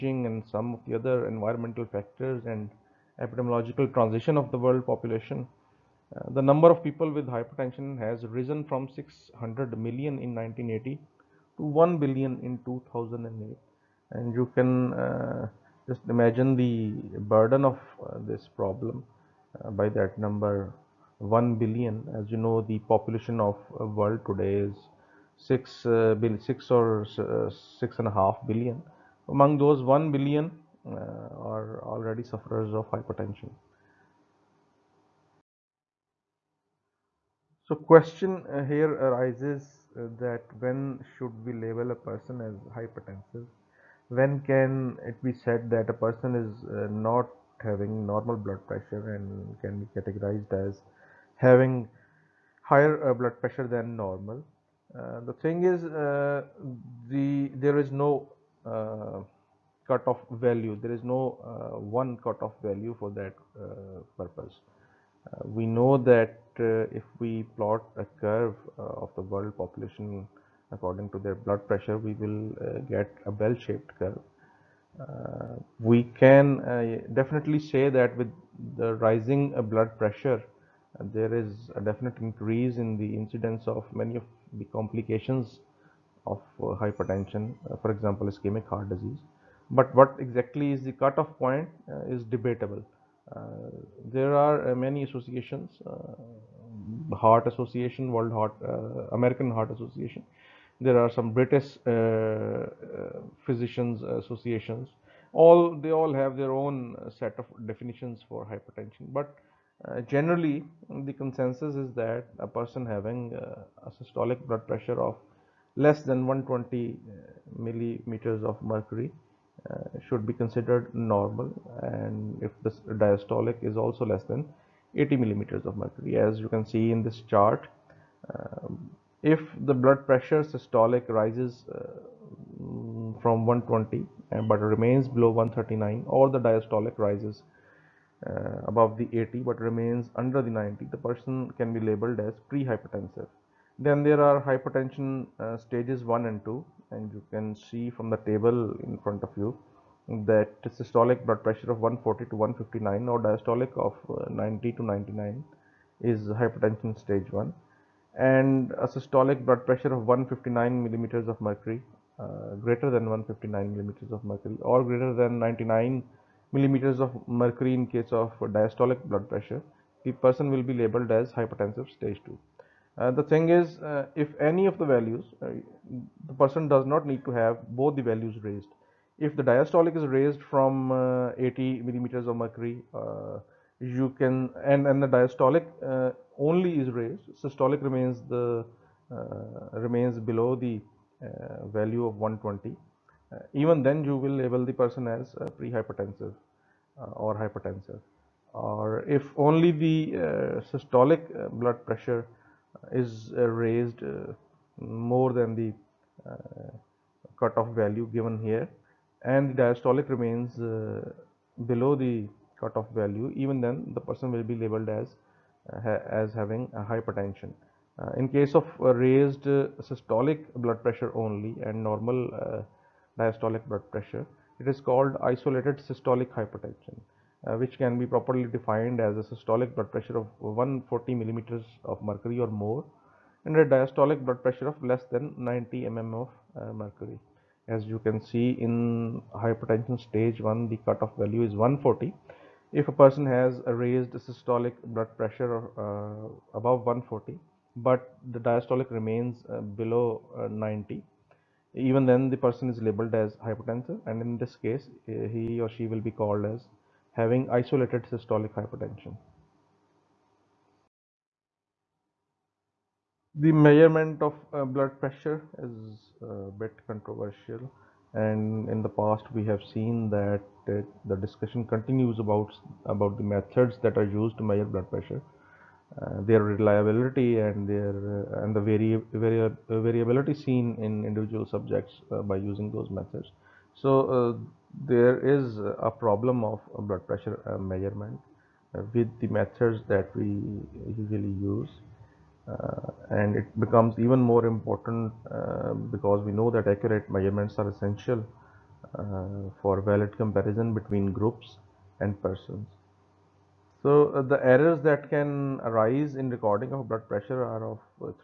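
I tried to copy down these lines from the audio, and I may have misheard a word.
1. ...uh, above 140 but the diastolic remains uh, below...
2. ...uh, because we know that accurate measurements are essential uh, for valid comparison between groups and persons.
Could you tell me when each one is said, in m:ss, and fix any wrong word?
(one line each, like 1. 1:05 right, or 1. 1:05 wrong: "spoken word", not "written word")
1. 4:05 right
2. 4:55 right.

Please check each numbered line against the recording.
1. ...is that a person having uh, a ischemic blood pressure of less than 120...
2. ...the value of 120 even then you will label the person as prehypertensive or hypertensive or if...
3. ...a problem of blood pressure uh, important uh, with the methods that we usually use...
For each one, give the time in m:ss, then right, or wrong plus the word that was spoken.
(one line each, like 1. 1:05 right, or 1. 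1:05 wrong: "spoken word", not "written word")
1. 1:51 wrong: "systolic", not "ischemic"
2. 3:10 right
3. 4:45 wrong: "measurement", not "important".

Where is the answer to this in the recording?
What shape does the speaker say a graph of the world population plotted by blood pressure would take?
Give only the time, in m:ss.
1:13.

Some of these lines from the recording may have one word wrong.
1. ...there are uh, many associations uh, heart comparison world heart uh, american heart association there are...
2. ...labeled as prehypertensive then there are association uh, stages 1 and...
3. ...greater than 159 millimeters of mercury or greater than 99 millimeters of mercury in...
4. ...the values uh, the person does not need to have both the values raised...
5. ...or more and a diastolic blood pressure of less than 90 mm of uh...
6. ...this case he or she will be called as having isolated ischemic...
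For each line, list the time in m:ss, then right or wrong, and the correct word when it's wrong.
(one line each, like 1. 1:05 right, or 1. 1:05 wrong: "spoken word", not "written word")
1. 1:34 wrong: "association", not "comparison"
2. 2:21 wrong: "hypertension", not "association"
3. 2:42 right
4. 2:54 right
5. 3:52 right
6. 4:14 wrong: "systolic", not "ischemic".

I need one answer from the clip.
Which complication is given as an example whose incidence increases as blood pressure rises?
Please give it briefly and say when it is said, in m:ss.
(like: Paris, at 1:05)
Ischemic heart disease, at 1:28.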